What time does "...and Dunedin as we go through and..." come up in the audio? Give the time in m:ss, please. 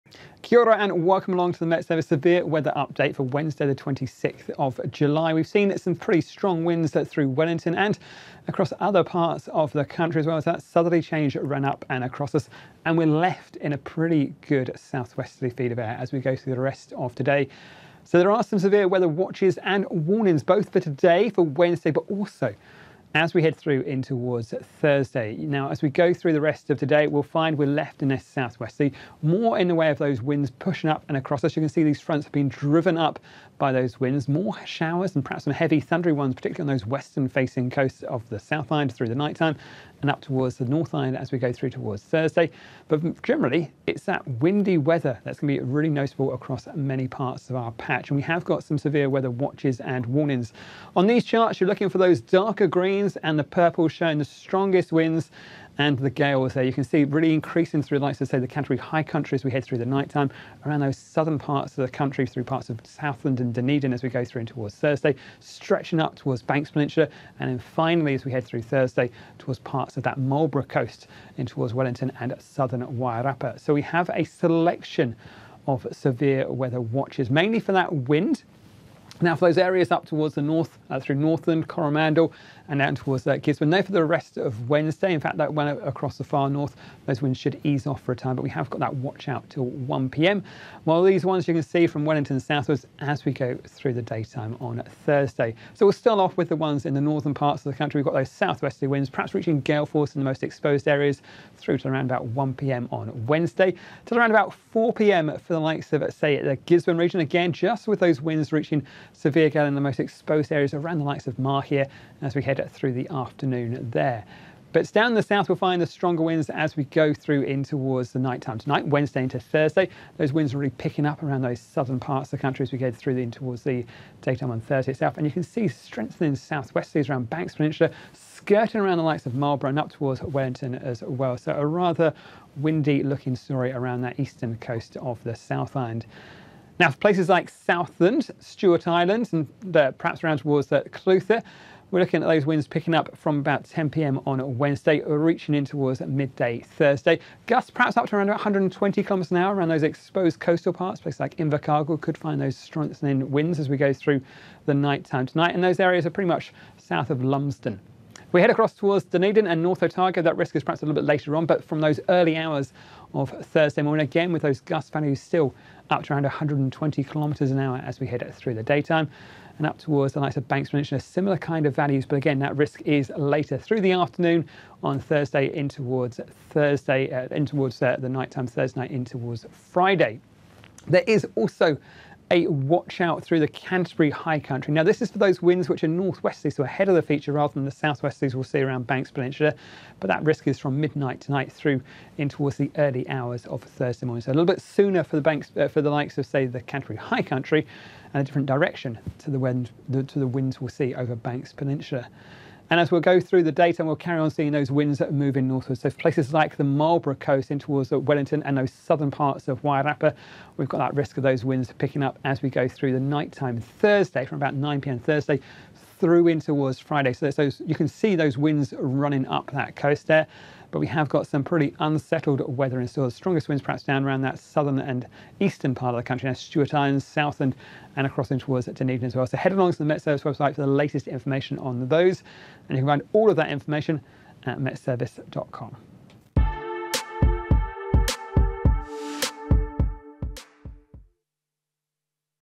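1:03.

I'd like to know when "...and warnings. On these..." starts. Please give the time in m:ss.
0:49.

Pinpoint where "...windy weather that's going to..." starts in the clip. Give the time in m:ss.
0:44.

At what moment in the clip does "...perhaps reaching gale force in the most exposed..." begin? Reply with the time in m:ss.
1:39.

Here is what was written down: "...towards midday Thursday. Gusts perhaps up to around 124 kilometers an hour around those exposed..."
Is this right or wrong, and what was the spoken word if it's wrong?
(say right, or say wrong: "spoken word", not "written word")
wrong: "120", not "124".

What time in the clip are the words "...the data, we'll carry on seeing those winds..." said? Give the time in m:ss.
3:23.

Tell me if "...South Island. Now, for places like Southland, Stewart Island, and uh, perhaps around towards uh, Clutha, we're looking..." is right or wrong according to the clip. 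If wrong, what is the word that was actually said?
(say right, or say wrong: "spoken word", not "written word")
right.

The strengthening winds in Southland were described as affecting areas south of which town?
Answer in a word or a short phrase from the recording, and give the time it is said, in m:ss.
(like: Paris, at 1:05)
Lumsden, at 2:37.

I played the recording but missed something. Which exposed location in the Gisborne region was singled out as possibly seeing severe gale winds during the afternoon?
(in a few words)
Mahia.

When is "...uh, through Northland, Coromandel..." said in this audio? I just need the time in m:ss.
1:20.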